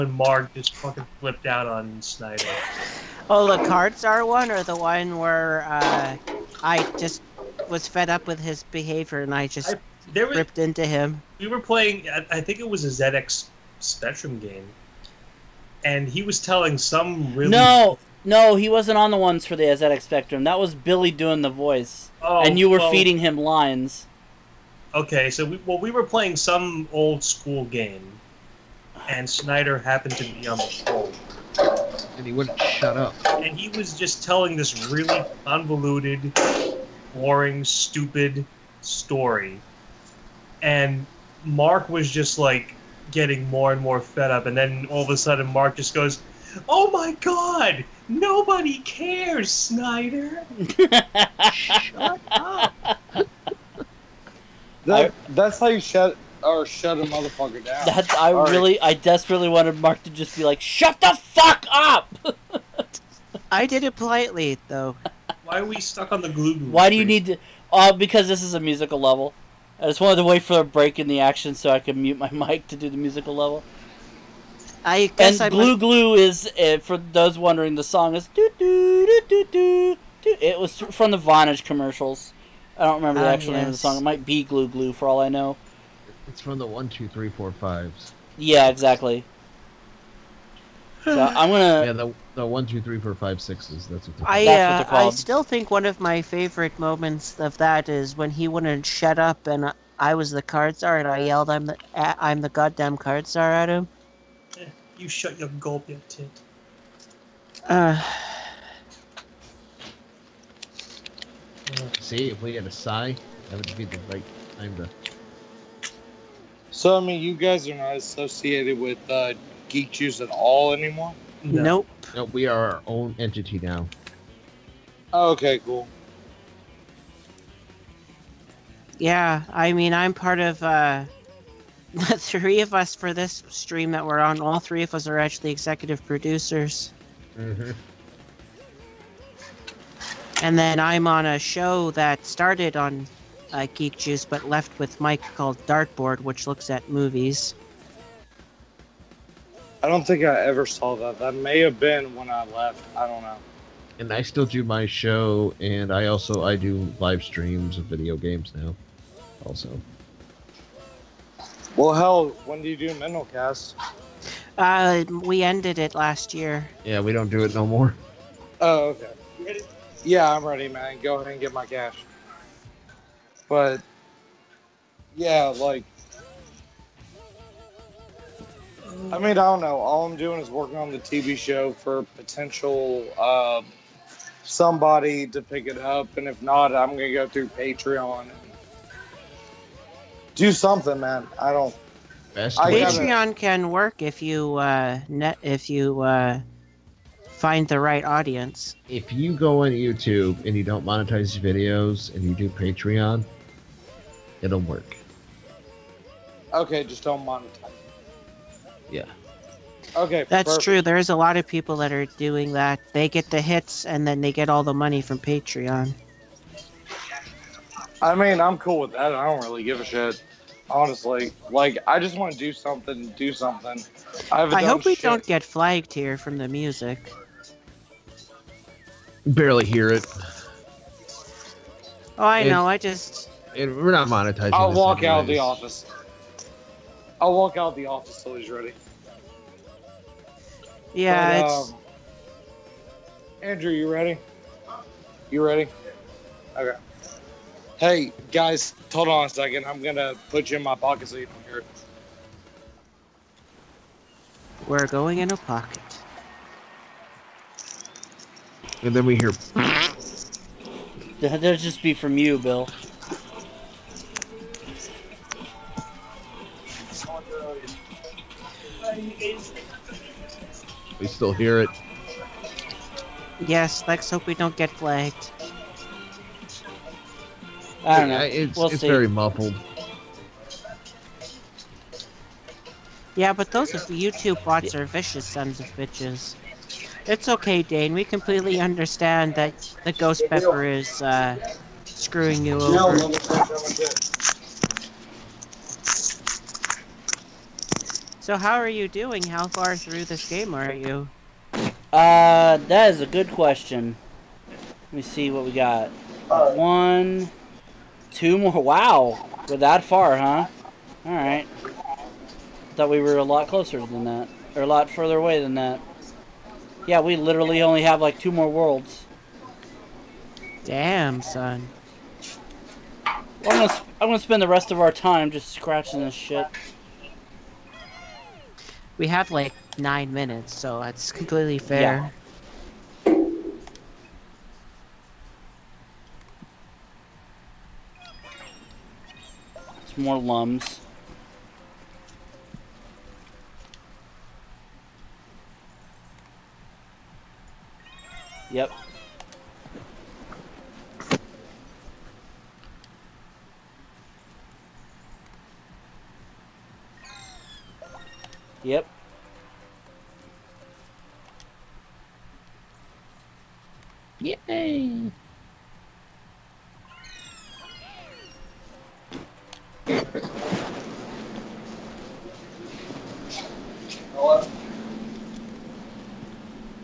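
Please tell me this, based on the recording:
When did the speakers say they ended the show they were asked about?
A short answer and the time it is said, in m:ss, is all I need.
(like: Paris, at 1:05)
Last year, at 2:45.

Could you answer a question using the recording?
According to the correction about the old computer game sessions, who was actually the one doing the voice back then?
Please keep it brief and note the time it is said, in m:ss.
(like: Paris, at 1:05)
Billy, at 0:20.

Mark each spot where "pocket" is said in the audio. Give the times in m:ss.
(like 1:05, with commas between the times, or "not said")
4:10, 4:15.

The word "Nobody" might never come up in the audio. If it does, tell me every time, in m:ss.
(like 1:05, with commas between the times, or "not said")
0:48.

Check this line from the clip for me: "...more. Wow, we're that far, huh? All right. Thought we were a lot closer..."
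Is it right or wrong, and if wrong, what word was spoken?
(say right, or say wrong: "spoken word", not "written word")
right.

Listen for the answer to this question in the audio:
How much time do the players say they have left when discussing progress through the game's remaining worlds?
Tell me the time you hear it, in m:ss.
5:29.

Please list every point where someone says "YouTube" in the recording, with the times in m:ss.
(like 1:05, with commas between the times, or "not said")
3:19, 4:43.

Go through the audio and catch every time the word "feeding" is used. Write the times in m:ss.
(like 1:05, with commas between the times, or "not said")
0:22.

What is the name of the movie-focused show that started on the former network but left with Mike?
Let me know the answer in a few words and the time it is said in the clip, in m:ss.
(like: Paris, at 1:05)
Dartboard, at 2:25.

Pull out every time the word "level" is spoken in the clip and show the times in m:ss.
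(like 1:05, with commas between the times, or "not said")
1:09, 1:13.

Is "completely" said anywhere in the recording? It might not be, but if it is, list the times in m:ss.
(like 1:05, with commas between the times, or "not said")
4:48, 5:31.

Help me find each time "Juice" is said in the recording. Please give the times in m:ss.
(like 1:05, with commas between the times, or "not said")
1:59, 2:23.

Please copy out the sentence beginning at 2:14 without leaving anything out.
All three of us are actually executive producers.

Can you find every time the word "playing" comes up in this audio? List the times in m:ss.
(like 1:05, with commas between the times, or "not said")
0:11, 0:26.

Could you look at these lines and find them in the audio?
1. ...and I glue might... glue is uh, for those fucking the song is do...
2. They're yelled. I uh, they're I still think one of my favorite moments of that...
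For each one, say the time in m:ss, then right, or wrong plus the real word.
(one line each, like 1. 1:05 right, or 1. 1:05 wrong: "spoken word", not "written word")
1. 1:15 wrong: "wondering", not "fucking"
2. 1:34 wrong: "called", not "yelled".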